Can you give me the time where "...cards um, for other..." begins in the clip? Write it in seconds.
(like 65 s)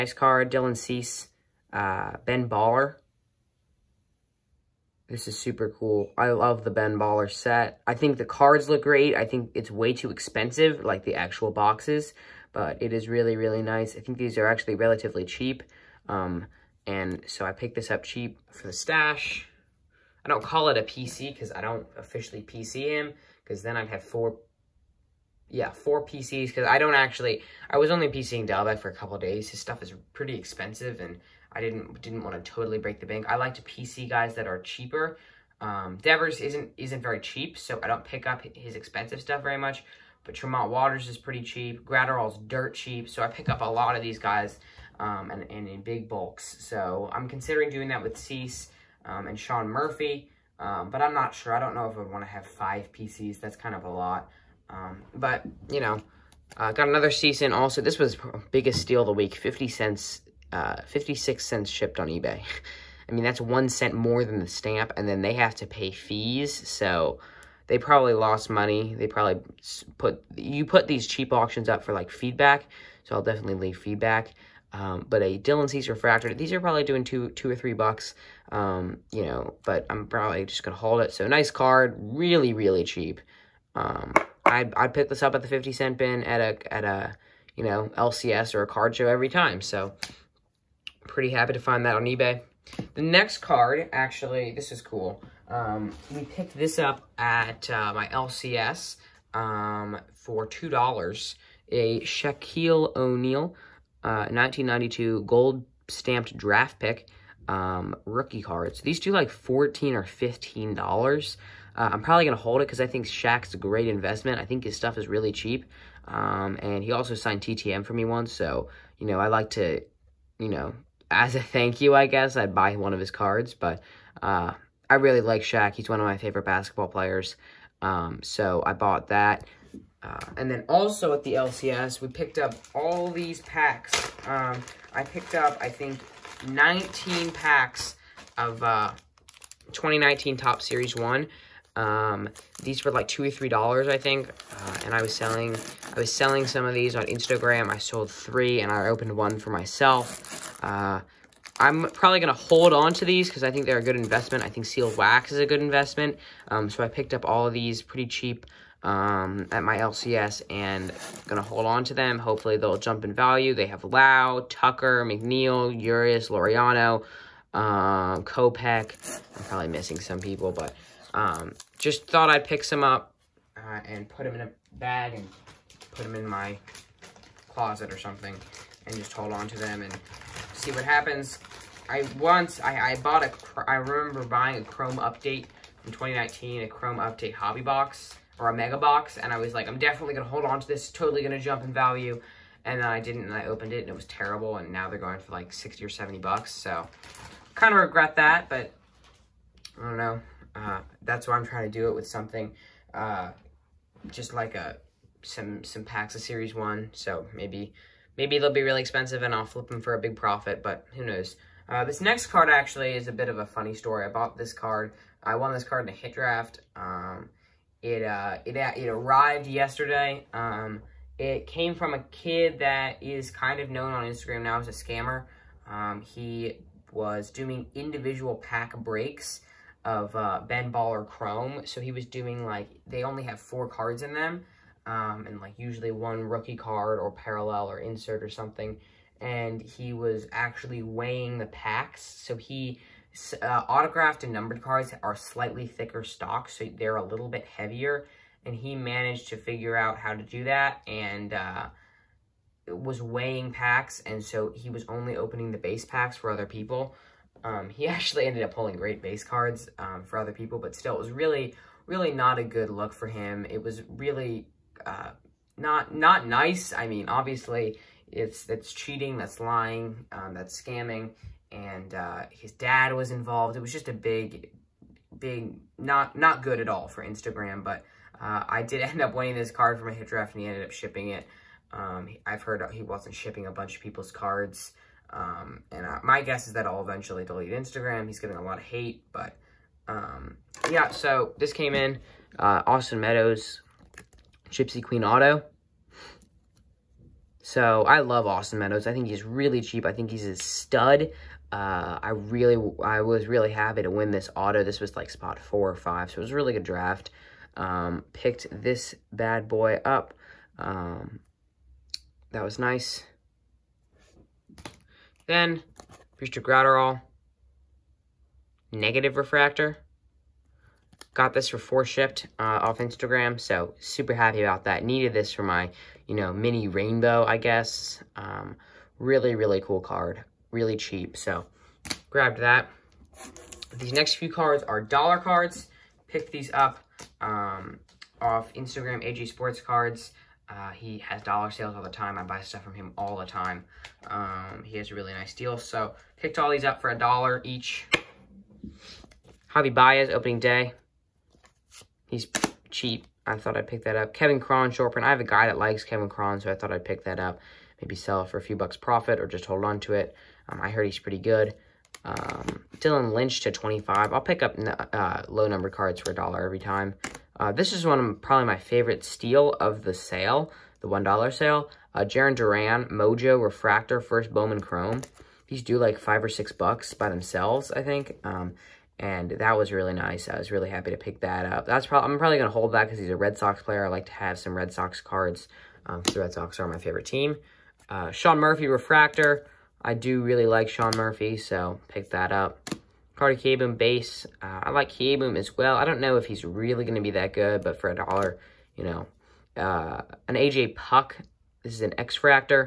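259 s.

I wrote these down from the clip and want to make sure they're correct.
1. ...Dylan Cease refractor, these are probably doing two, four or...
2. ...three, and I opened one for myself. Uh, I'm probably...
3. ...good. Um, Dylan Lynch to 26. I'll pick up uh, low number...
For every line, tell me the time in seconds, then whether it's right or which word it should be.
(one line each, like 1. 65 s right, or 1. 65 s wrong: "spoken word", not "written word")
1. 75 s wrong: "two", not "four"
2. 148 s right
3. 361 s wrong: "25", not "26".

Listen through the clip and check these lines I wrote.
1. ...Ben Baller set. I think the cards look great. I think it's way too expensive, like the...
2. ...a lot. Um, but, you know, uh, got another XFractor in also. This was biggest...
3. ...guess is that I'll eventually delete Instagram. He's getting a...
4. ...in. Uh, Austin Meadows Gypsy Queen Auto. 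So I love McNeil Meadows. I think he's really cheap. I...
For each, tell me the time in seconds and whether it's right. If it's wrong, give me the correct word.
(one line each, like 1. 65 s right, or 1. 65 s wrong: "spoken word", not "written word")
1. 6 s right
2. 53 s wrong: "Cease", not "XFractor"
3. 286 s right
4. 291 s wrong: "Austin", not "McNeil".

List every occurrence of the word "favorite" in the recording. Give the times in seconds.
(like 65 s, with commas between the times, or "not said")
126 s, 368 s, 386 s.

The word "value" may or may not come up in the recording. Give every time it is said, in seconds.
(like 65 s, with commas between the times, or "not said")
163 s, 191 s.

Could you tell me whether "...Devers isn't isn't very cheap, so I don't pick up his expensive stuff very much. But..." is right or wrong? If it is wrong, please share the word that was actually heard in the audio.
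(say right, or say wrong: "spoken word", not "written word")
right.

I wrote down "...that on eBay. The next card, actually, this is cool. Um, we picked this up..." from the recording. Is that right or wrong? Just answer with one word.
right.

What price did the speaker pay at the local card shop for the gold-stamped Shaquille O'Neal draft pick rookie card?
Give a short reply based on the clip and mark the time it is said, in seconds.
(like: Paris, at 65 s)
$2, at 100 s.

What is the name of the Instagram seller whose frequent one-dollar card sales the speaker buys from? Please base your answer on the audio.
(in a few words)
AG Sports Cards.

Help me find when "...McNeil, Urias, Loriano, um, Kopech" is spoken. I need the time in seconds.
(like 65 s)
165 s.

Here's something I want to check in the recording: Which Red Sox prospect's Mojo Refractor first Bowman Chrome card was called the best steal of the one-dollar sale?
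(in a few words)
Jarren Duran.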